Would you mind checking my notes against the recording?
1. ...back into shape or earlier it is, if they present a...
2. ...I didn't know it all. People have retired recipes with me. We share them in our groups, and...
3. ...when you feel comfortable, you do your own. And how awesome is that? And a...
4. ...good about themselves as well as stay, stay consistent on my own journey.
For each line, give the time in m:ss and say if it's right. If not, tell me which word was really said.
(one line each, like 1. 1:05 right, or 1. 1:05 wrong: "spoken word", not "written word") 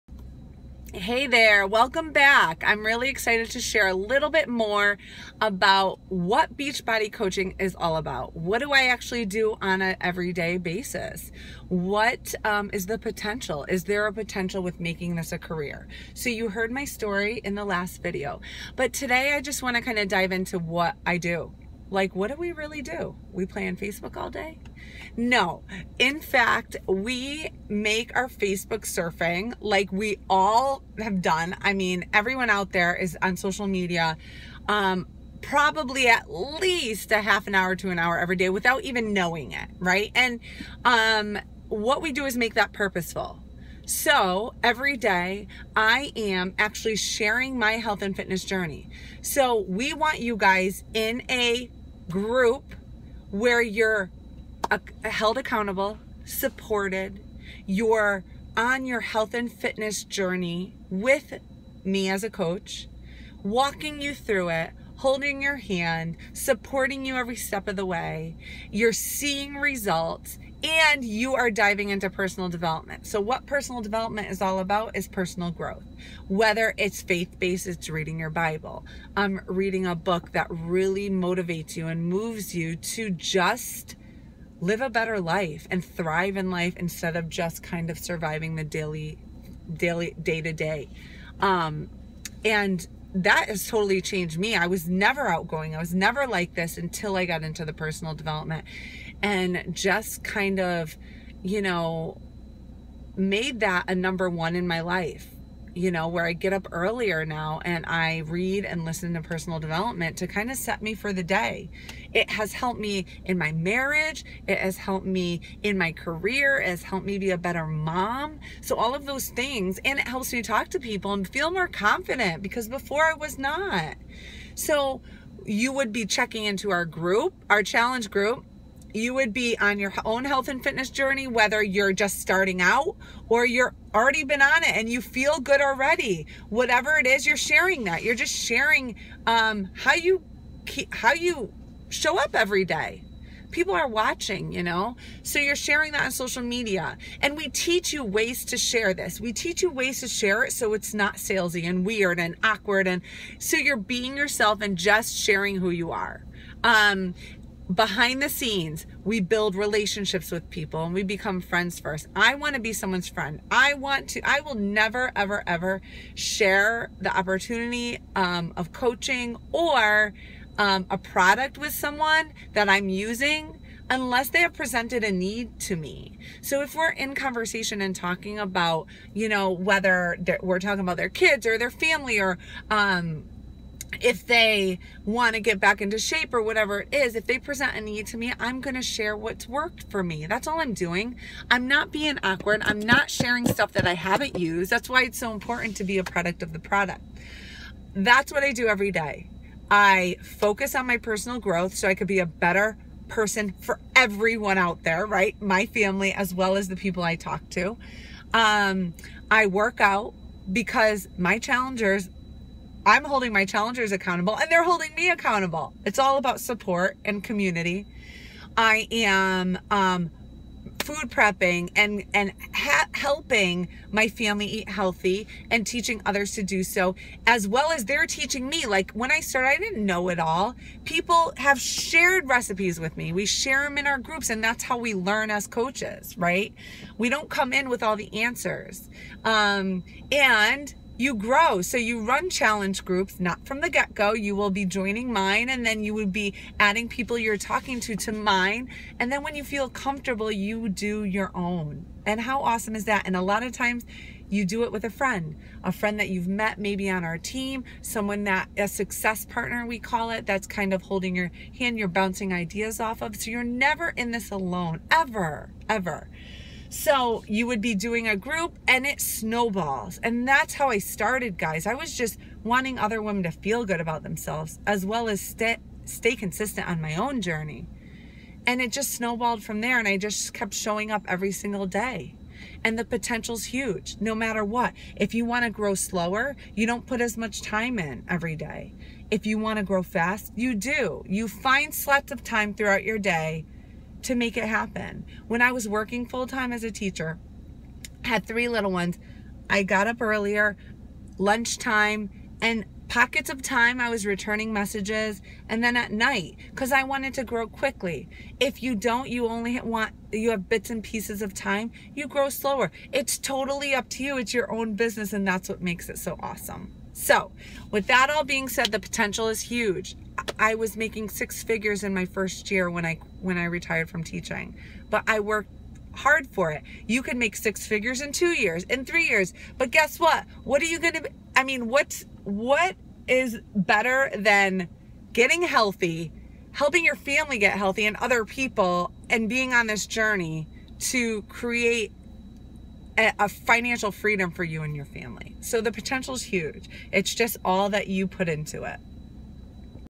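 1. 3:05 wrong: "whatever", not "earlier"
2. 3:49 wrong: "shared", not "retired"
3. 4:09 right
4. 4:33 right.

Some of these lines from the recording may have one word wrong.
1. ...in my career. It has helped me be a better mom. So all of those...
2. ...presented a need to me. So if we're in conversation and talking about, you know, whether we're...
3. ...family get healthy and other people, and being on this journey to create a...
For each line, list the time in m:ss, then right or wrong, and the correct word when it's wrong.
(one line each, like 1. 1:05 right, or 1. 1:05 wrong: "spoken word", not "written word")
1. 1:55 right
2. 2:54 right
3. 5:36 right.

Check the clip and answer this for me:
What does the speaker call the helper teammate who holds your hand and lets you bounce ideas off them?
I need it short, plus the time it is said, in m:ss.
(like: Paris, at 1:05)
success partner, at 4:18.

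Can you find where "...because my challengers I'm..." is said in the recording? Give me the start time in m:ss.
3:30.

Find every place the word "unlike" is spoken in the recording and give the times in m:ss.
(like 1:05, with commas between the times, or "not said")
not said.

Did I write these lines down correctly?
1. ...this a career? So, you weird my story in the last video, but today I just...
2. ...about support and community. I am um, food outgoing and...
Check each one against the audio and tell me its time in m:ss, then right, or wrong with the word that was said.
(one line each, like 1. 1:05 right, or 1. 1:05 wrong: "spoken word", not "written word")
1. 0:15 wrong: "heard", not "weird"
2. 3:36 wrong: "prepping", not "outgoing".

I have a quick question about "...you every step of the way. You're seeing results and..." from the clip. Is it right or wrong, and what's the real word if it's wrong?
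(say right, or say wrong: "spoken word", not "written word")
right.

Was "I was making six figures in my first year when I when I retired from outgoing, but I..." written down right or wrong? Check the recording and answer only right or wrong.
wrong.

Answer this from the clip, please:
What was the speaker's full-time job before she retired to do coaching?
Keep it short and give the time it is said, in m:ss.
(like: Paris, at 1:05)
teacher, at 4:56.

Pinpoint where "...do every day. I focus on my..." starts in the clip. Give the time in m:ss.
3:18.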